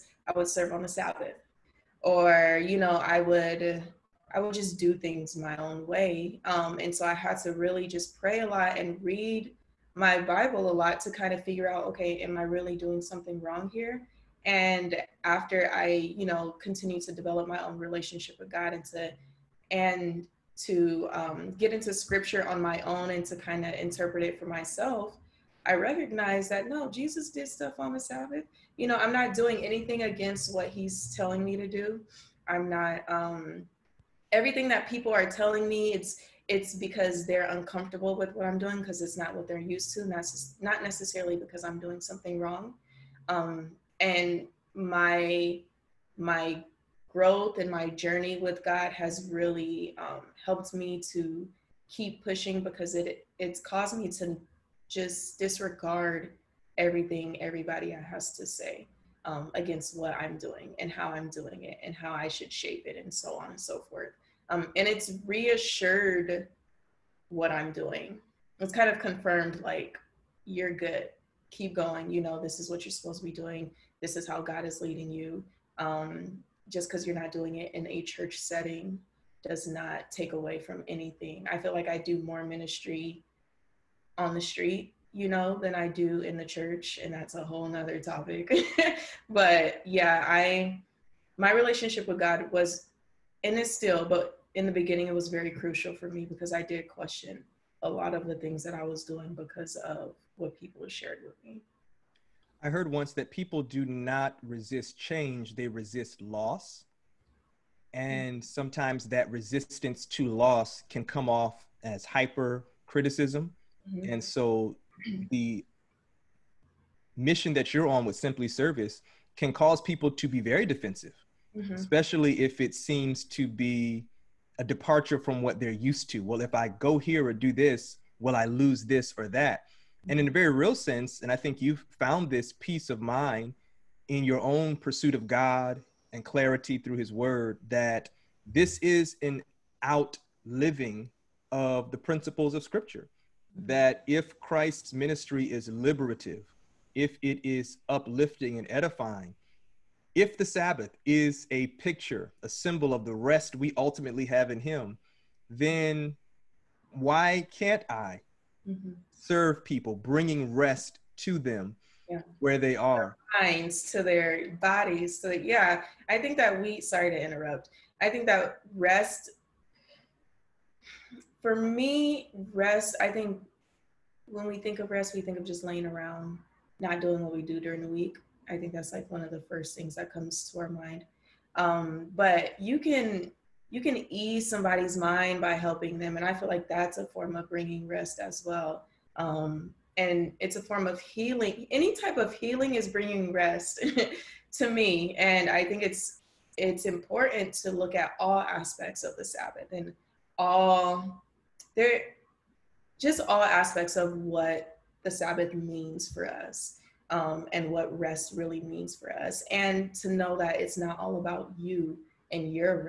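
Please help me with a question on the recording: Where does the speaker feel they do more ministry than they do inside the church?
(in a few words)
On the street.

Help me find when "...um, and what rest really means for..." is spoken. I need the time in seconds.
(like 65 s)
207 s.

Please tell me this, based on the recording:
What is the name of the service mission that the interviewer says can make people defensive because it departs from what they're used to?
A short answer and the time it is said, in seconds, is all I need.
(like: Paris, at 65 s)
Simpli Service, at 118 s.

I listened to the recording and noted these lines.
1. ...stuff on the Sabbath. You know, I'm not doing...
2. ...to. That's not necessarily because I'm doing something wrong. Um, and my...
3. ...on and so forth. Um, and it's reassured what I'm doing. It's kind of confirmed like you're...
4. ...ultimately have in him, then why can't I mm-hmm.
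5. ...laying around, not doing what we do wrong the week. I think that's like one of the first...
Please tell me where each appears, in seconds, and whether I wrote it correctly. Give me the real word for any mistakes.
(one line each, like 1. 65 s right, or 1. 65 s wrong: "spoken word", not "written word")
1. 27 s right
2. 39 s right
3. 63 s right
4. 153 s right
5. 175 s wrong: "during", not "wrong".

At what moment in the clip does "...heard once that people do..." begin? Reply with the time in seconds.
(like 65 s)
102 s.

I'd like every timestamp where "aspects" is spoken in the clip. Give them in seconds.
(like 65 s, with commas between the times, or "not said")
198 s, 203 s.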